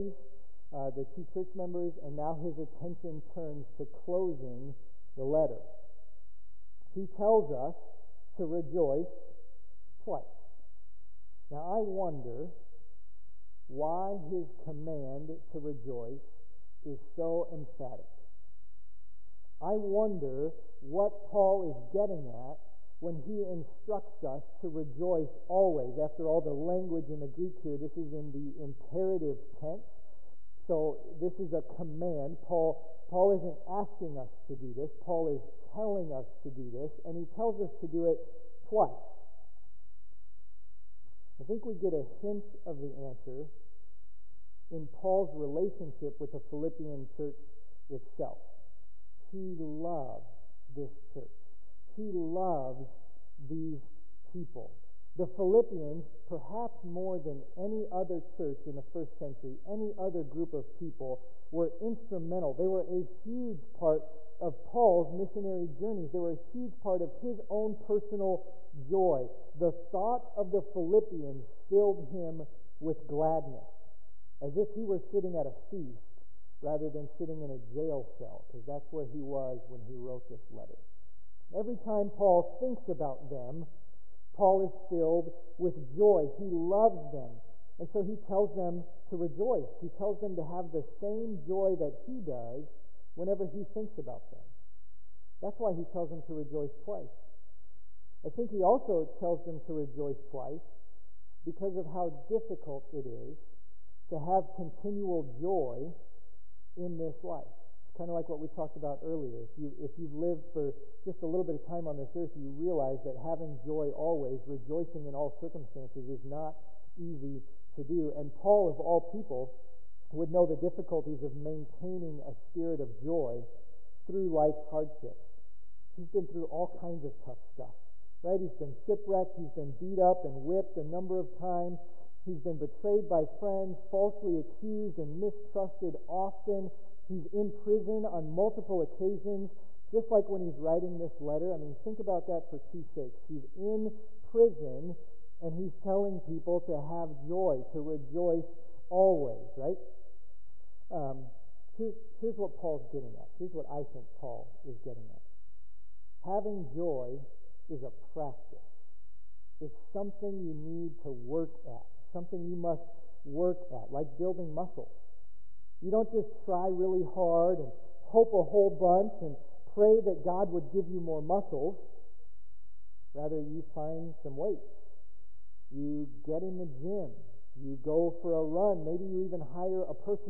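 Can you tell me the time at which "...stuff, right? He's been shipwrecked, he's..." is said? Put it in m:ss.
2:07.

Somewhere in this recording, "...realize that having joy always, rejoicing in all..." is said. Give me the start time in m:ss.
1:52.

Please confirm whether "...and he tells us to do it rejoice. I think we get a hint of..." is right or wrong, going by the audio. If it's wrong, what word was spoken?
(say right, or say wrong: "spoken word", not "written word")
wrong: "twice", not "rejoice".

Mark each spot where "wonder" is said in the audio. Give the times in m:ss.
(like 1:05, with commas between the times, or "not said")
0:11, 0:19.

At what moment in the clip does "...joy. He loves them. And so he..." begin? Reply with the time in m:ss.
1:25.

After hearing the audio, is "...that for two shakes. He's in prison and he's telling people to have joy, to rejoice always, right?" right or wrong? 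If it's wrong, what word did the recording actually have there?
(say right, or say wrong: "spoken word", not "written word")
right.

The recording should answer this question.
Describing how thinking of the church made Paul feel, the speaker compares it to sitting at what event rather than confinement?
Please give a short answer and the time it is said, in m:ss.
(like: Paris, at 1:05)
A feast, at 1:15.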